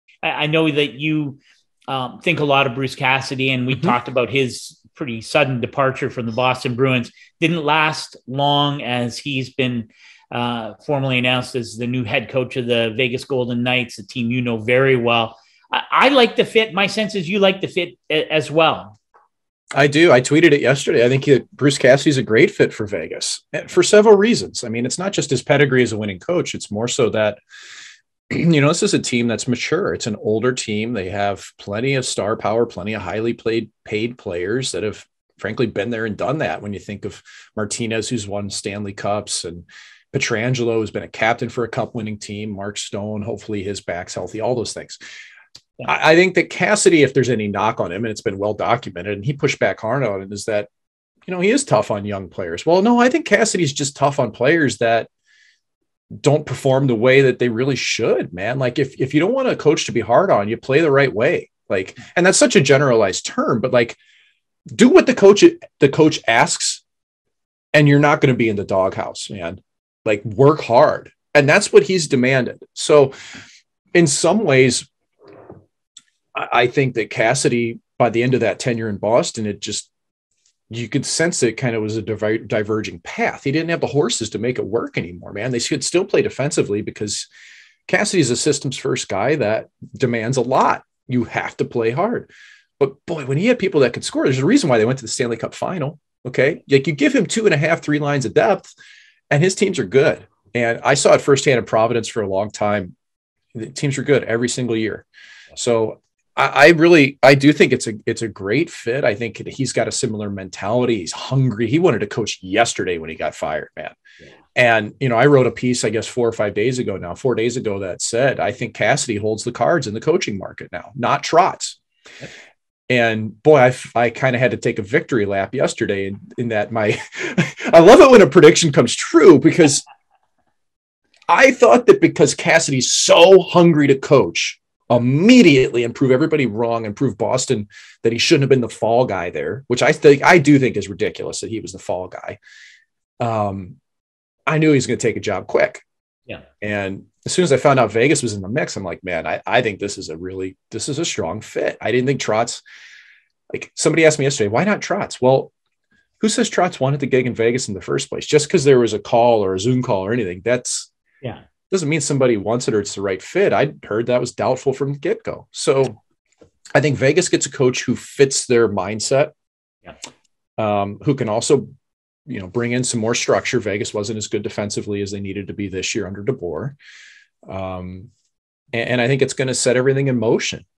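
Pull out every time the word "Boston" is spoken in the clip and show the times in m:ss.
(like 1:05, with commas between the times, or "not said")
0:06, 1:18, 2:17.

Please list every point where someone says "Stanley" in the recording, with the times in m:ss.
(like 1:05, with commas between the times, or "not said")
0:38, 1:35.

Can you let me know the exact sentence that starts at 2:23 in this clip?
Um, I knew he was going to take a job quick.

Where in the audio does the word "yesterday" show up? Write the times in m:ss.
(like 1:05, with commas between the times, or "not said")
0:20, 1:52, 2:05, 2:34.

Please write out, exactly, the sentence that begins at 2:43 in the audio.
I heard that was doubtful from the get go.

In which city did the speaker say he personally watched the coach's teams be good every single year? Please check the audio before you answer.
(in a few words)
Providence.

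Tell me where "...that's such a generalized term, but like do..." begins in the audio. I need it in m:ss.
1:02.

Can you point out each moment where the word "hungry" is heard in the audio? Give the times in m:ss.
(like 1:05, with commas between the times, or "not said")
1:51, 2:13.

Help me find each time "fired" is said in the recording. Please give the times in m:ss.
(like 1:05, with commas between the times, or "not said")
1:53.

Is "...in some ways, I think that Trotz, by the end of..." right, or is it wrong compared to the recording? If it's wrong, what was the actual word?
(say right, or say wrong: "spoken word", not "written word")
wrong: "Cassidy", not "Trotz".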